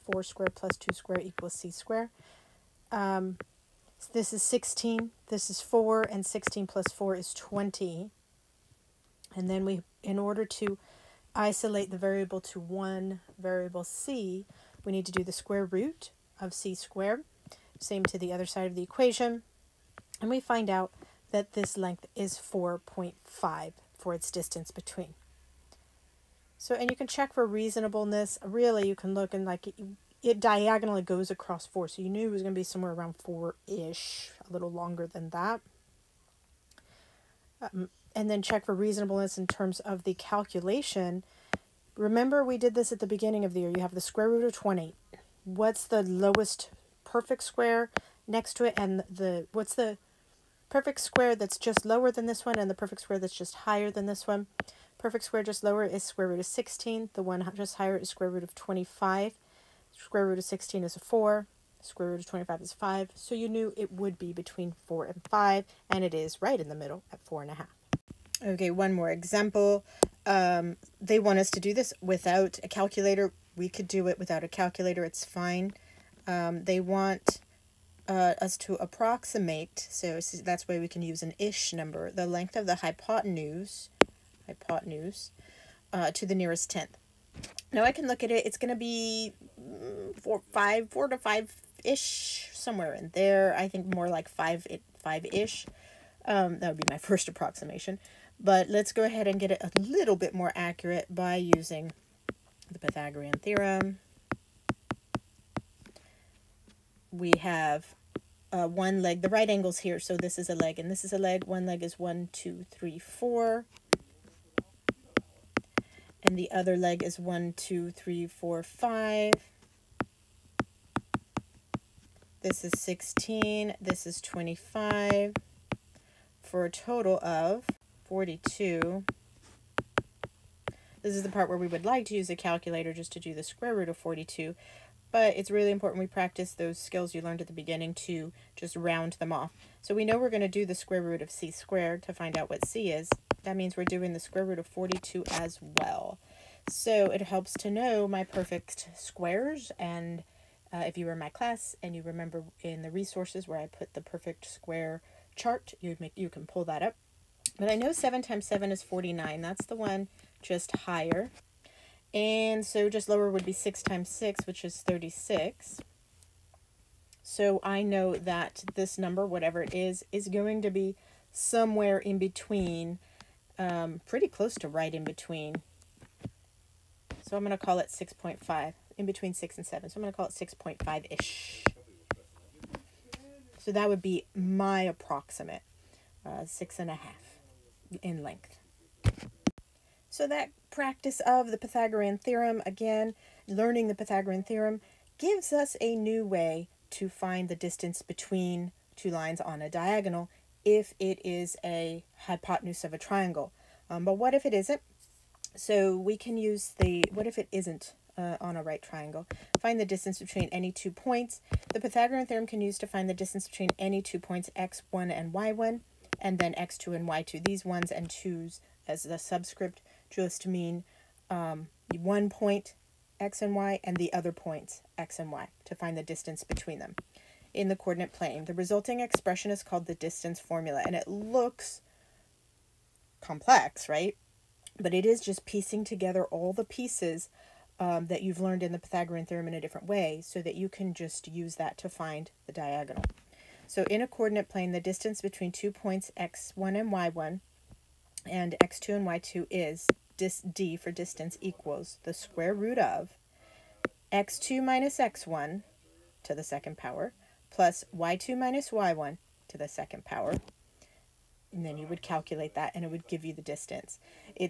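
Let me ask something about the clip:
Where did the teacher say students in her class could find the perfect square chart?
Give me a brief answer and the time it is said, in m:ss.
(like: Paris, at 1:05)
in the resources, at 2:32.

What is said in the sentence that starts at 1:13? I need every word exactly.
We could do it without a calculator.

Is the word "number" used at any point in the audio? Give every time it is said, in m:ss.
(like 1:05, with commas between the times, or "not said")
1:21, 2:48.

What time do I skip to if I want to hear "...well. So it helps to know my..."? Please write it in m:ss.
2:25.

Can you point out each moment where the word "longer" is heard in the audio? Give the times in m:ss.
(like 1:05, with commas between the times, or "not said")
0:34.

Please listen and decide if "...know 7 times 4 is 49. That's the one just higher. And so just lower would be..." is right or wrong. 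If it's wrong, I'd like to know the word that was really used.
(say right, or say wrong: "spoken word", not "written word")
wrong: "7", not "4".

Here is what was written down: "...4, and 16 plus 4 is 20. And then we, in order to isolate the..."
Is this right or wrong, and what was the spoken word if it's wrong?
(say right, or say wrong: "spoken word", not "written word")
right.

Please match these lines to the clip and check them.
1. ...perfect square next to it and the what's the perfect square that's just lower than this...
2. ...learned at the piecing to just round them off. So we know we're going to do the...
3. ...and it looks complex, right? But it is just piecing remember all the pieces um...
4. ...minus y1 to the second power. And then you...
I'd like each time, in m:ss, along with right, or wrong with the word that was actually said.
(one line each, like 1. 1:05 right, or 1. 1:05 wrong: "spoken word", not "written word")
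1. 0:47 right
2. 2:17 wrong: "beginning", not "piecing"
3. 3:50 wrong: "together", not "remember"
4. 4:18 right.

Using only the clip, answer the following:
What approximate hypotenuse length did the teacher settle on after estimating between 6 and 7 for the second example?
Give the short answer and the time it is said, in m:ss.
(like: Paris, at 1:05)
6.5, at 3:00.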